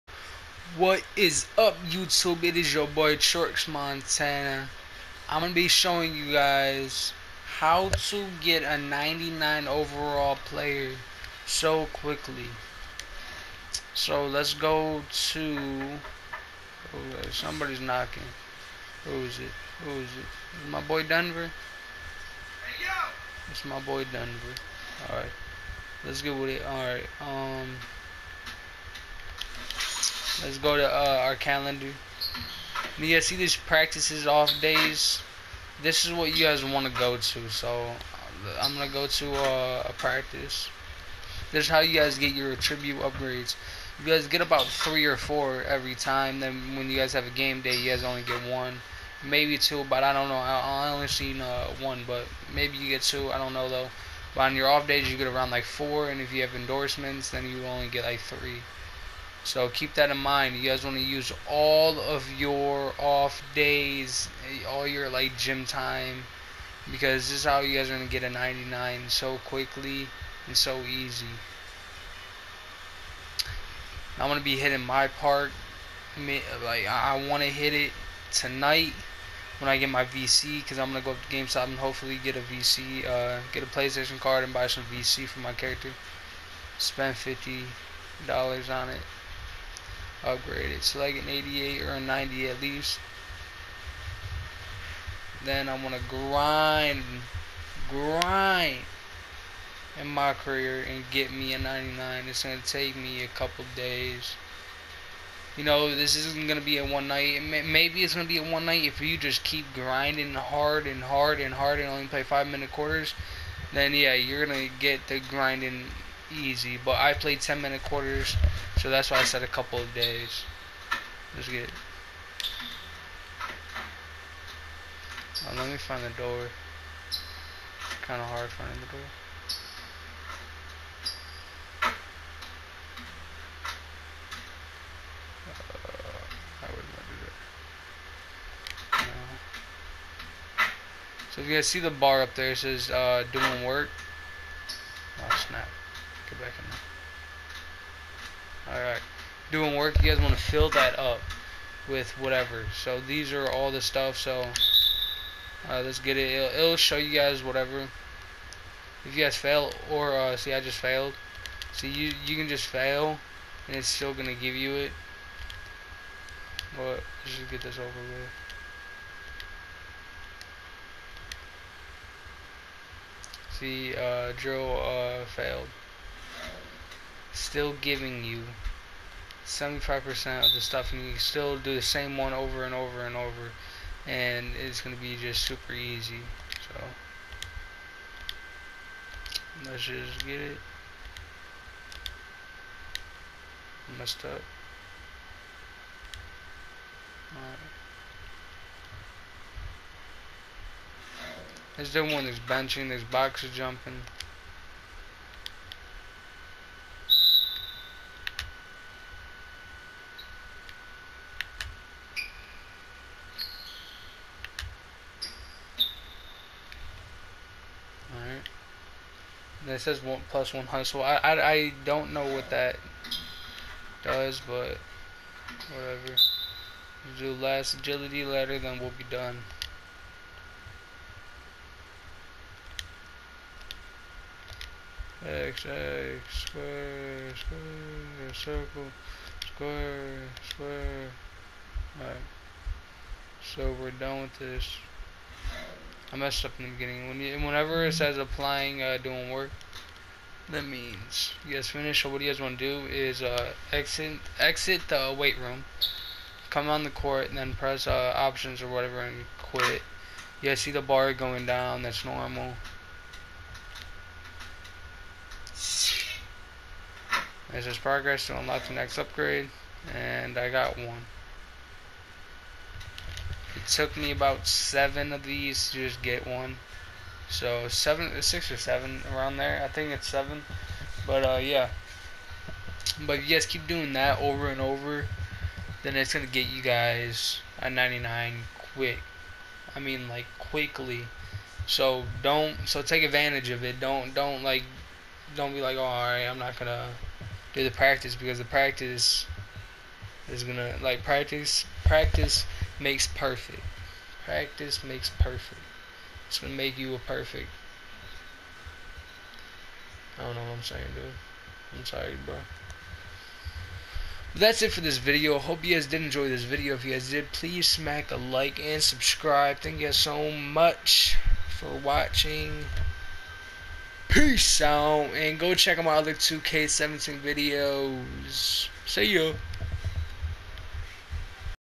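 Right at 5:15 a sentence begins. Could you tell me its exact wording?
Hope you guys did enjoy this video.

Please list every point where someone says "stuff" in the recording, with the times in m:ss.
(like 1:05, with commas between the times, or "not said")
2:33, 3:00.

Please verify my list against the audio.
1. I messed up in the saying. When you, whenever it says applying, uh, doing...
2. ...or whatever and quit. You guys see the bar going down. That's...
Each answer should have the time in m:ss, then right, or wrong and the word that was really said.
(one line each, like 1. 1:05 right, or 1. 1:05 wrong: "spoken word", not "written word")
1. 4:06 wrong: "beginning", not "saying"
2. 4:18 right.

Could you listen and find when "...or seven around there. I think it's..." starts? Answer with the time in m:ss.
4:38.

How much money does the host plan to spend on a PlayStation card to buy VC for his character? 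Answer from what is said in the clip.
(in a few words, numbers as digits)
$50.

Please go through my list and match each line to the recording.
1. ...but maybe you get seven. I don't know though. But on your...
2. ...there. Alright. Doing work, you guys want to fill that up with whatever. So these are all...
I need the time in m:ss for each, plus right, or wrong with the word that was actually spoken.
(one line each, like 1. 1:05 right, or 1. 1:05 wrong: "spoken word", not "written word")
1. 0:52 wrong: "two", not "seven"
2. 2:28 right.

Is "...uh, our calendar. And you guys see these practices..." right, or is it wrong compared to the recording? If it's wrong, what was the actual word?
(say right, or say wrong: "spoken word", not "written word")
right.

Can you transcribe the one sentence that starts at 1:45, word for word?
You know, this isn't going to be a one night.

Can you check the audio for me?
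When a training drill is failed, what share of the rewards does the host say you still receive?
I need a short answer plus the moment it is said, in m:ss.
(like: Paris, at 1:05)
75%, at 2:59.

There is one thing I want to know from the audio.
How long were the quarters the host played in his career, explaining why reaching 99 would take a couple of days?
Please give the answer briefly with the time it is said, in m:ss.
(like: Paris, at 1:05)
10 minutes, at 1:57.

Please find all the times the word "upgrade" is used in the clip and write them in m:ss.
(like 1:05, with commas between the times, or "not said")
0:43, 1:30, 4:28.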